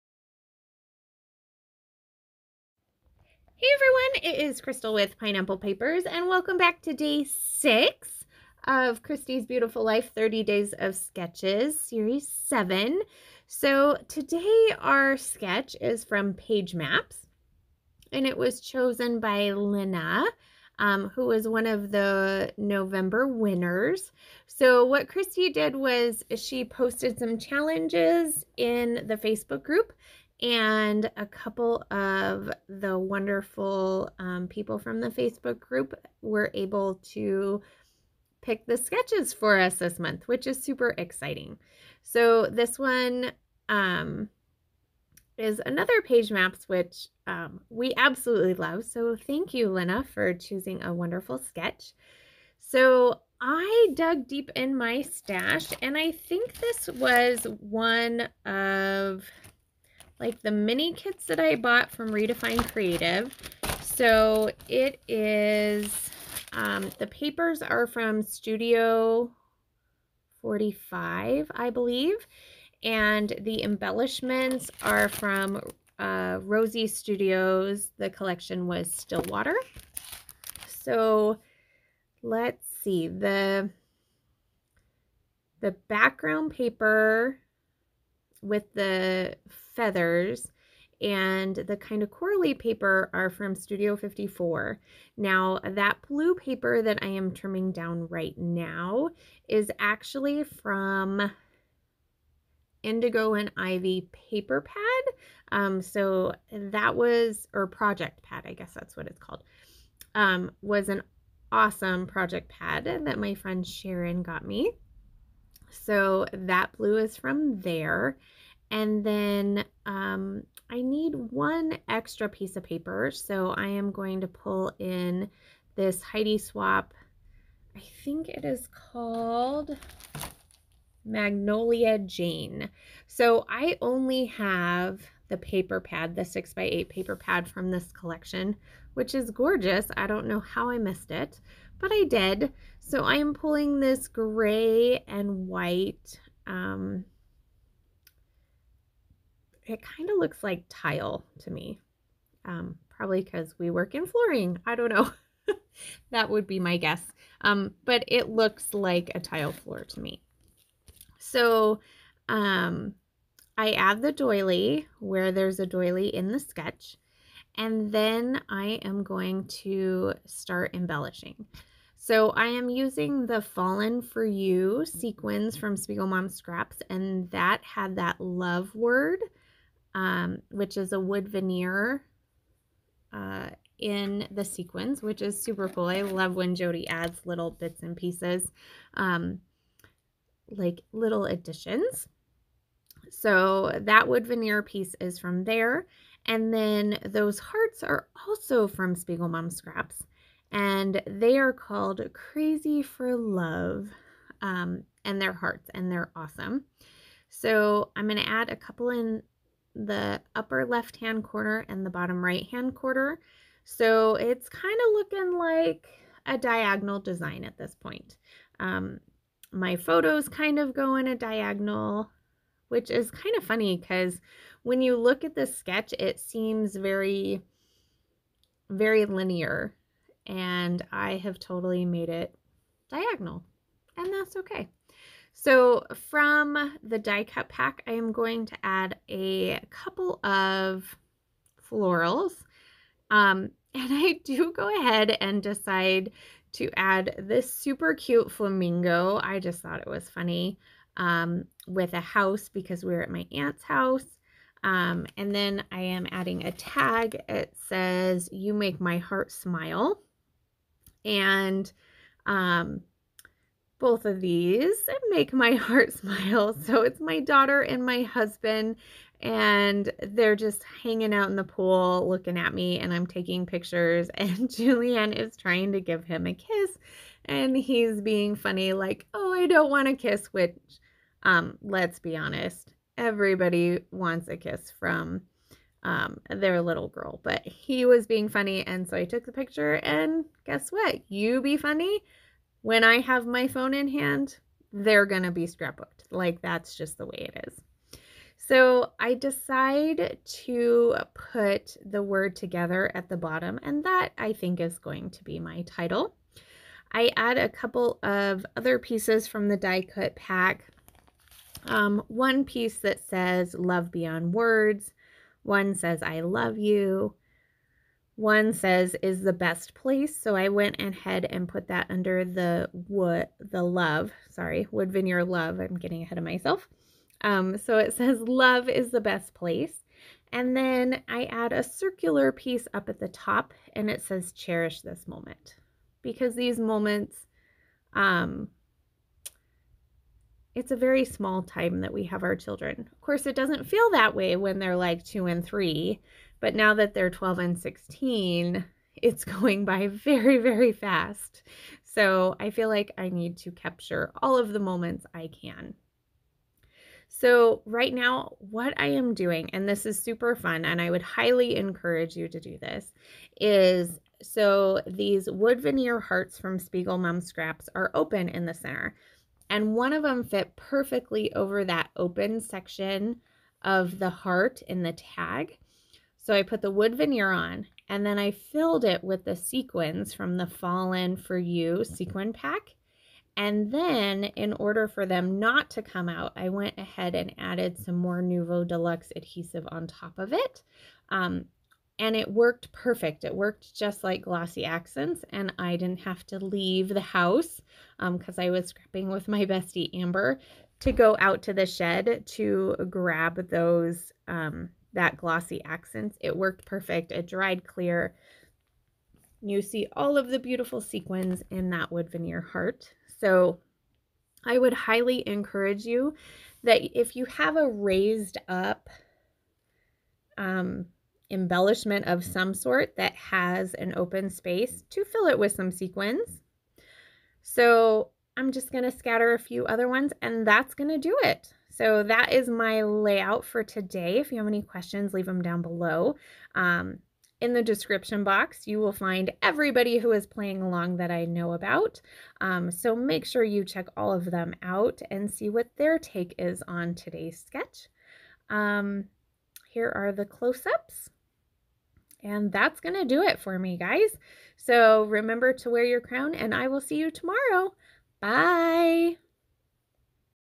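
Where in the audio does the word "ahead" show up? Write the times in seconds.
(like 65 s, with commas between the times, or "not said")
244 s, 320 s, 326 s, 386 s.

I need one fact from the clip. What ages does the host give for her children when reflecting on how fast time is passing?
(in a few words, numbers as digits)
12 and 16.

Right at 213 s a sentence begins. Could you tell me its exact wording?
So it's kind of looking like a diagonal design at this point.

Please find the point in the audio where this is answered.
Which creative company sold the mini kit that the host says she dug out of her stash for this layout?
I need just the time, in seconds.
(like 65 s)
62 s.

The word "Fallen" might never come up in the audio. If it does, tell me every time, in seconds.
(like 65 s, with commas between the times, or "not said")
173 s, 380 s.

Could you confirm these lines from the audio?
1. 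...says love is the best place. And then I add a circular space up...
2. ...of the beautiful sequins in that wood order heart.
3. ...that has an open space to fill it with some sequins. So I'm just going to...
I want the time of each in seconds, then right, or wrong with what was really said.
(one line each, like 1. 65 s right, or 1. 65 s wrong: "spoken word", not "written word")
1. 327 s wrong: "piece", not "space"
2. 410 s wrong: "veneer", not "order"
3. 422 s right.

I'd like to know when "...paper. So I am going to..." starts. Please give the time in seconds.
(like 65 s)
122 s.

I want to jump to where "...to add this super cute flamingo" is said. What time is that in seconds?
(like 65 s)
246 s.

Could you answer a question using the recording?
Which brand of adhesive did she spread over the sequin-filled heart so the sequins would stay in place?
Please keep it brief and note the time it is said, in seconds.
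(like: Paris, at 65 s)
Nuvo Deluxe, at 388 s.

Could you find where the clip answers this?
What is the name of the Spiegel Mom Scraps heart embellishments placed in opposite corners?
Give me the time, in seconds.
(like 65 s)
202 s.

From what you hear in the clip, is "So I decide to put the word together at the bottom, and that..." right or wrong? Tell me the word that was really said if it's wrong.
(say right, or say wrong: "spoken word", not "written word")
right.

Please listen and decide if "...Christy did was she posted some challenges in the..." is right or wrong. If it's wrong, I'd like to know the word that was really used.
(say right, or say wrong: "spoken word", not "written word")
right.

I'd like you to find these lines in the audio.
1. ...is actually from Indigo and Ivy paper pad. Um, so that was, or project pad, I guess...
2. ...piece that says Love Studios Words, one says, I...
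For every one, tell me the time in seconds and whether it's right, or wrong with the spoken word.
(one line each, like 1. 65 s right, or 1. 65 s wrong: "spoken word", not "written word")
1. 99 s right
2. 312 s wrong: "Beyond", not "Studios".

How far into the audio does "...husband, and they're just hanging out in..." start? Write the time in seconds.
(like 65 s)
268 s.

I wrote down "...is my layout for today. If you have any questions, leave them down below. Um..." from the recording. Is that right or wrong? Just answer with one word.
right.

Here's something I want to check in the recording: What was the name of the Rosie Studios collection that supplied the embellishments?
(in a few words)
Stillwater.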